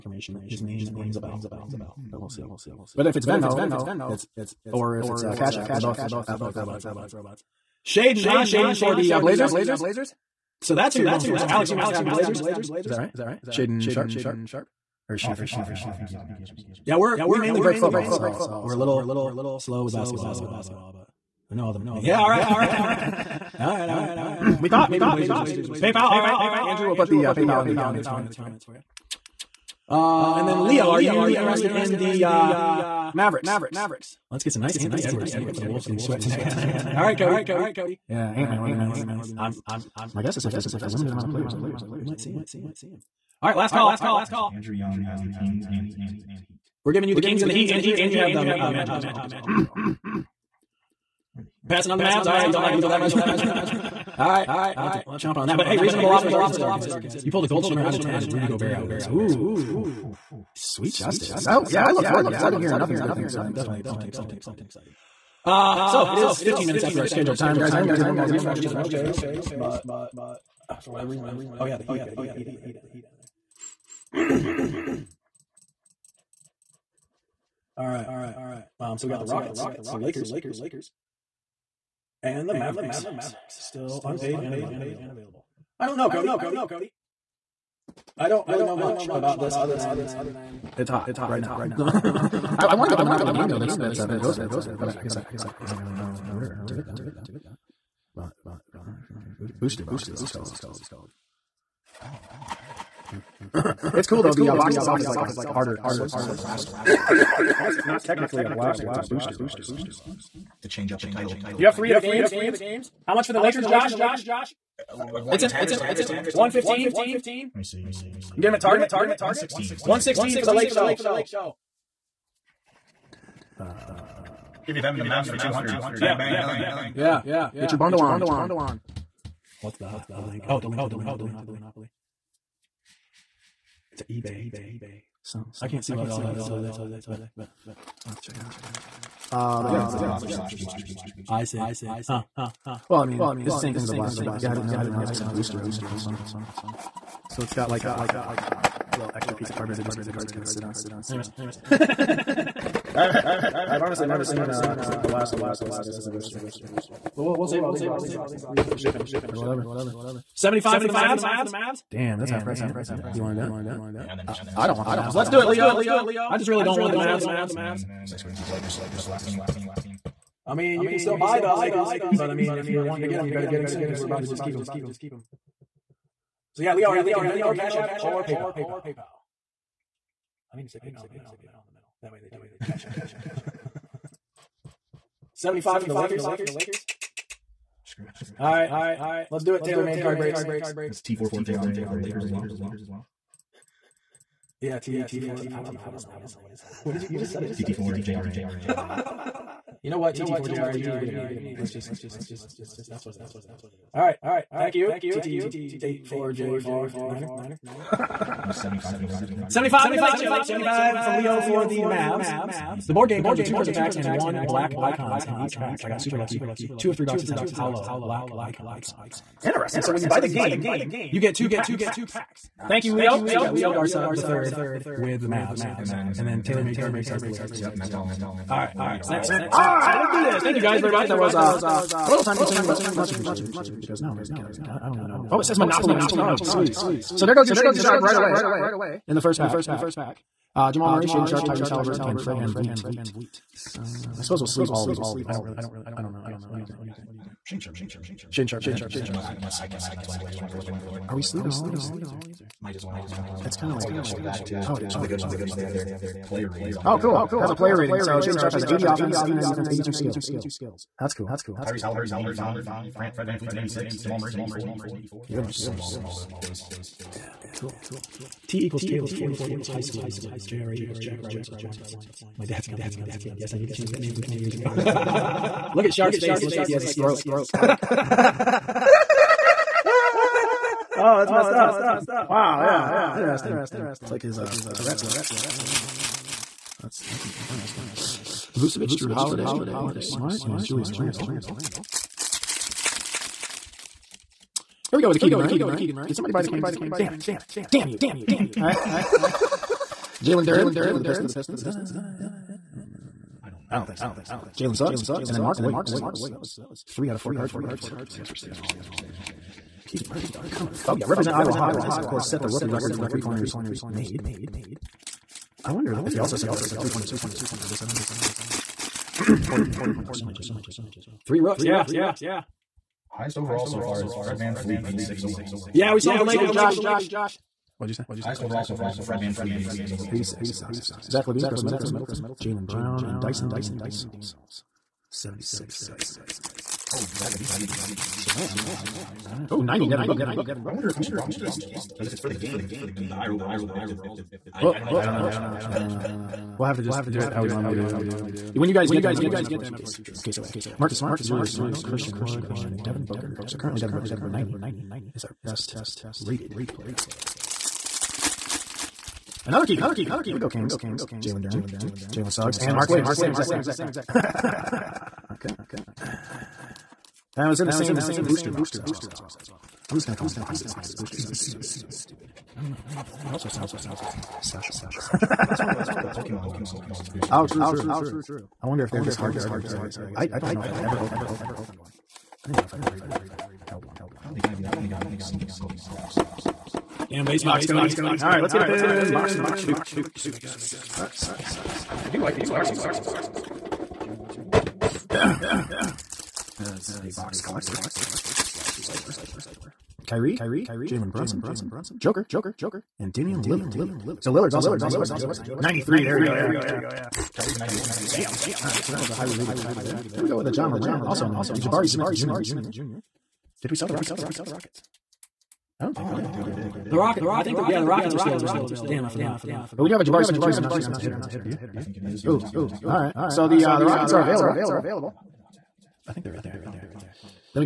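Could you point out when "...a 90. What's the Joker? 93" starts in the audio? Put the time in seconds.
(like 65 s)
404 s.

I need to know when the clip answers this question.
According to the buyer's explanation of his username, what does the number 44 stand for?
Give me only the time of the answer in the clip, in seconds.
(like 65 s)
269 s.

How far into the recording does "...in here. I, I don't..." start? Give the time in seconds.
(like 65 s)
234 s.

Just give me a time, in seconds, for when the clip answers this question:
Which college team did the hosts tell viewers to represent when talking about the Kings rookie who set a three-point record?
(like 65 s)
311 s.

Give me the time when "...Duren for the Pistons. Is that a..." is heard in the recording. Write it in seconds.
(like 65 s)
300 s.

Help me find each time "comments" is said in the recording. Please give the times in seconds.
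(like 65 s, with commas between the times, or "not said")
27 s.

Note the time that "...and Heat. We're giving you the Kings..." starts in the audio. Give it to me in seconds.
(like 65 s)
45 s.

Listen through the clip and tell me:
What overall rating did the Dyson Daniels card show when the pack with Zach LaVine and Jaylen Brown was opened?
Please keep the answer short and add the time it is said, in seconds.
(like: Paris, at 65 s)
76, at 335 s.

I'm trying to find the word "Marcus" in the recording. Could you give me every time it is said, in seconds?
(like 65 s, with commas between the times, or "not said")
289 s, 350 s.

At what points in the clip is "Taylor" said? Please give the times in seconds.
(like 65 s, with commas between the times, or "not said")
226 s, 268 s.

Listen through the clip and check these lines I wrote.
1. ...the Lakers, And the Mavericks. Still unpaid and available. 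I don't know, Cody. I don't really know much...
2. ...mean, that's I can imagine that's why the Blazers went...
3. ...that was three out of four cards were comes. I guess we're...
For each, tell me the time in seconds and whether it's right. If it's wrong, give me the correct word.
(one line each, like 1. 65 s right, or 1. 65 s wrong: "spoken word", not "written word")
1. 79 s right
2. 249 s right
3. 306 s wrong: "rookies", not "comes".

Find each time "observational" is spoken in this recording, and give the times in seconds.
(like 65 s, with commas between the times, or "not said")
not said.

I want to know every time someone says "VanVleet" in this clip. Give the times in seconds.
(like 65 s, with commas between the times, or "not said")
242 s, 263 s, 324 s, 329 s.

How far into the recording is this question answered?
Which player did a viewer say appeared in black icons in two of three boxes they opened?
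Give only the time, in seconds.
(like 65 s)
217 s.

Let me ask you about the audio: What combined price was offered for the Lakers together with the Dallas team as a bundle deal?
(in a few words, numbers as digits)
200.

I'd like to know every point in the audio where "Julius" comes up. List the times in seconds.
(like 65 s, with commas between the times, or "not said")
290 s, 351 s.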